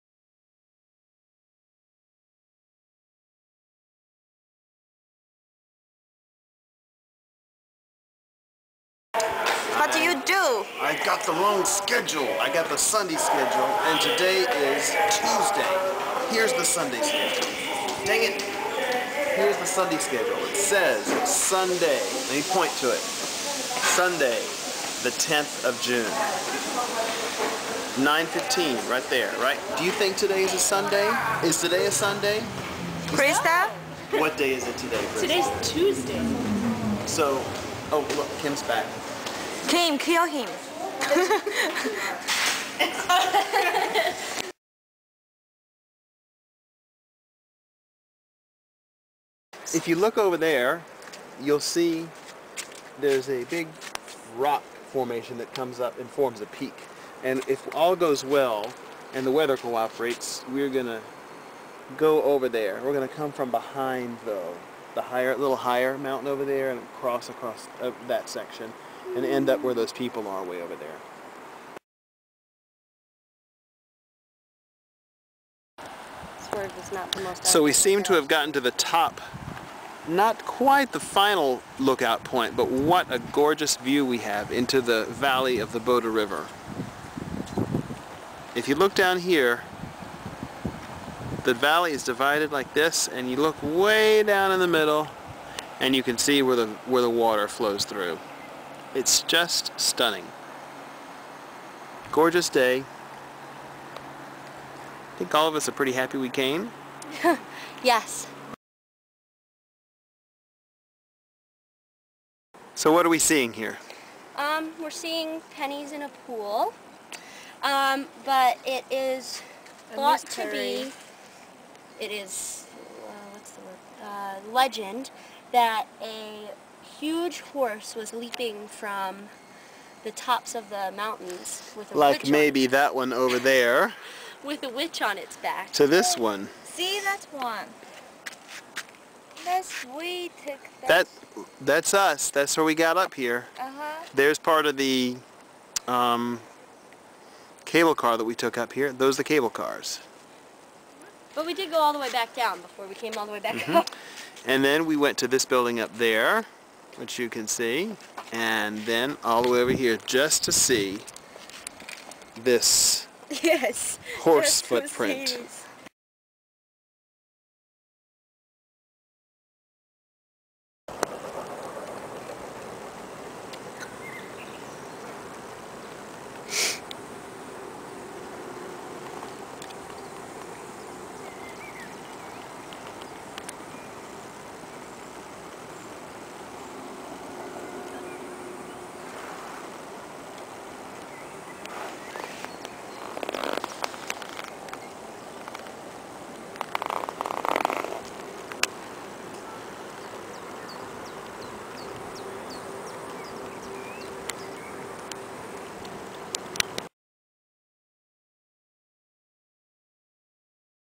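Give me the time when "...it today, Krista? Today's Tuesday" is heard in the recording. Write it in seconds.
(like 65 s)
34 s.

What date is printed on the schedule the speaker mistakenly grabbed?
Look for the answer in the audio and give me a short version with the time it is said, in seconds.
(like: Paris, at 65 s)
10th of June, at 25 s.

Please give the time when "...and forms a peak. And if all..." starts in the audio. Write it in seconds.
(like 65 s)
55 s.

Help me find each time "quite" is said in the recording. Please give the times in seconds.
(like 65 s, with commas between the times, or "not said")
80 s.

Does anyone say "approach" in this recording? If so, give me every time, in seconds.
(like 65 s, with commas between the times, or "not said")
not said.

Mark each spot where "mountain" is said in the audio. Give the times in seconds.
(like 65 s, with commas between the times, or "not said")
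65 s, 130 s.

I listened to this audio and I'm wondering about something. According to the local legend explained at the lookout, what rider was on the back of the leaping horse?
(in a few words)
a witch.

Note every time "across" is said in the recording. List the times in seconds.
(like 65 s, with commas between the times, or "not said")
67 s.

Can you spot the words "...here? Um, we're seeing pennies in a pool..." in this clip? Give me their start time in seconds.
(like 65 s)
113 s.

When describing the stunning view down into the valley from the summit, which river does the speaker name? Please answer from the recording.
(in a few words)
Bode River.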